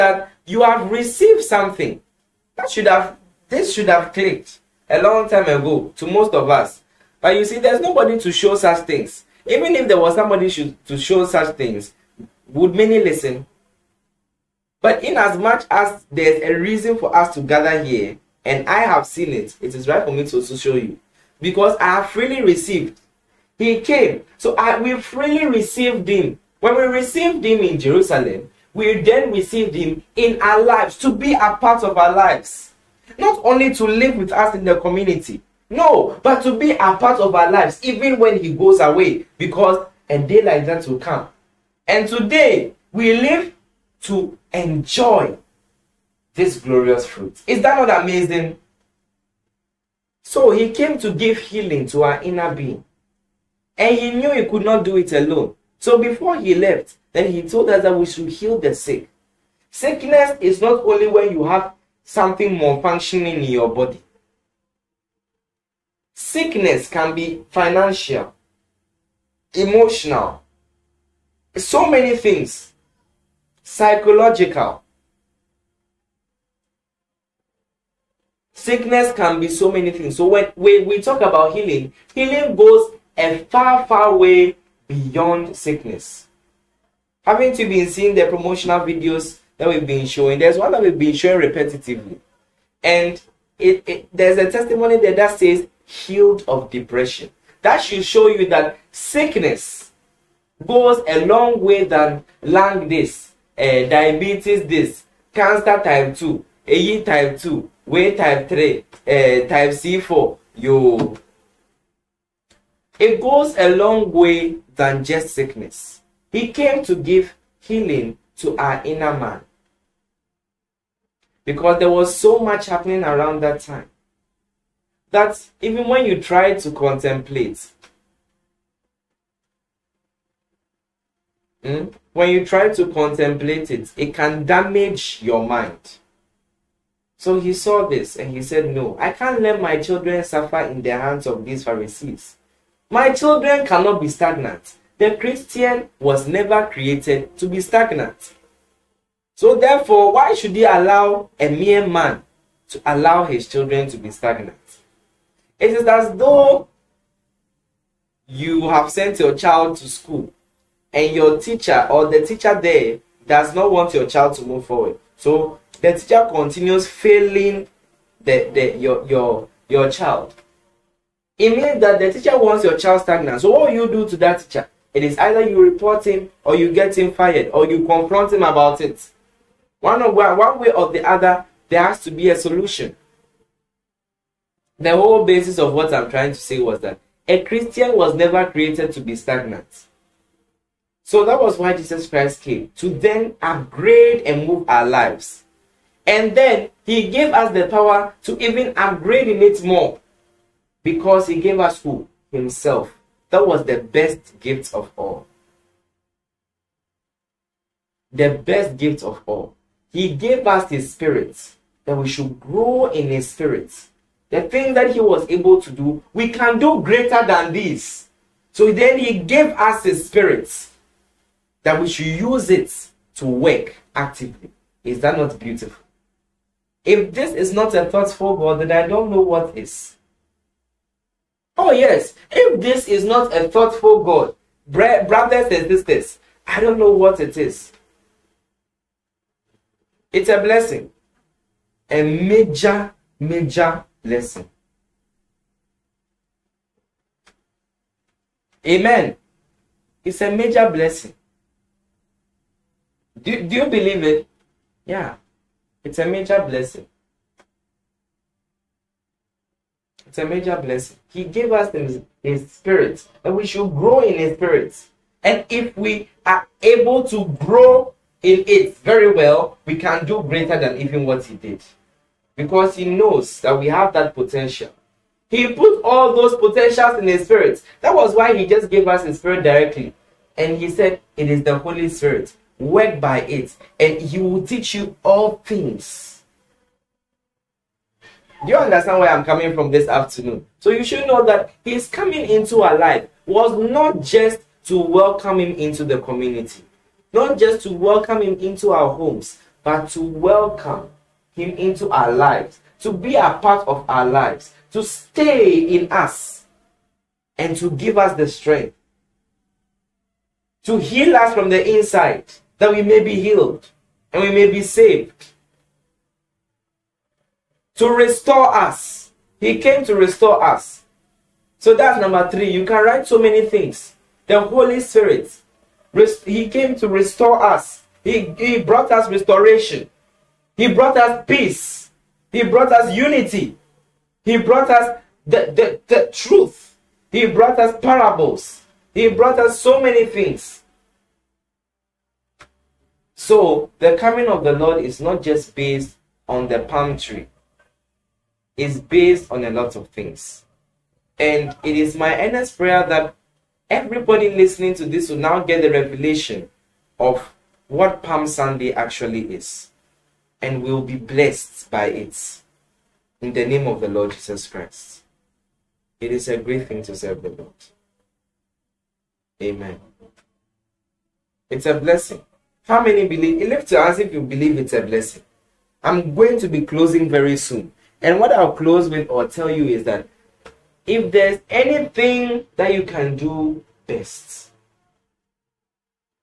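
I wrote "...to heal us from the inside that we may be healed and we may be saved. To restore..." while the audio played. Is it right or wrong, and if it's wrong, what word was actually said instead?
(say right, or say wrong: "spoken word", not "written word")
right.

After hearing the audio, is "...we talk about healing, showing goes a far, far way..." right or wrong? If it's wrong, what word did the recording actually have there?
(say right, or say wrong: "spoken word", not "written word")
wrong: "healing", not "showing".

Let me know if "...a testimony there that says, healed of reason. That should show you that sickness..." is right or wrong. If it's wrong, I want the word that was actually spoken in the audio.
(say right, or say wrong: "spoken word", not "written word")
wrong: "depression", not "reason".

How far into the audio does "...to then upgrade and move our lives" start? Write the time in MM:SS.
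03:12.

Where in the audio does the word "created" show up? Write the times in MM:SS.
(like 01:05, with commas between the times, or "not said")
02:26, 03:08.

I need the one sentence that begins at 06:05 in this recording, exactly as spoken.
It is a great thing to serve the Lord.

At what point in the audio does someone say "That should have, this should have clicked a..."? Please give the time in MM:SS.
00:02.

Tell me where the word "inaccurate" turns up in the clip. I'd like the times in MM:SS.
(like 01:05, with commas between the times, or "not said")
not said.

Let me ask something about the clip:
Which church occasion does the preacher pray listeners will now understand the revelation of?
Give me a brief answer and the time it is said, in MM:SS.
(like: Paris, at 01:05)
Palm Sunday, at 05:58.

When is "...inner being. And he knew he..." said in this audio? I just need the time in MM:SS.
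00:52.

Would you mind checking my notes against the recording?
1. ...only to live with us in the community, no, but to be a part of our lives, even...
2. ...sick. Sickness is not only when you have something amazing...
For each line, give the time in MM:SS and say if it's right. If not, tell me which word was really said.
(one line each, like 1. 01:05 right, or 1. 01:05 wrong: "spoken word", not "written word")
1. 00:33 right
2. 00:58 wrong: "malfunctioning", not "amazing".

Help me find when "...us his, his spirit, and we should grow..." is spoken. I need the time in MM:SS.
04:21.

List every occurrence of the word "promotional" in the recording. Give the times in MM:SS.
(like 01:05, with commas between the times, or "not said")
01:28.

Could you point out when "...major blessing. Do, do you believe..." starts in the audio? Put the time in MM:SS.
04:10.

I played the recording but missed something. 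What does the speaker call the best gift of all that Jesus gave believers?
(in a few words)
Himself.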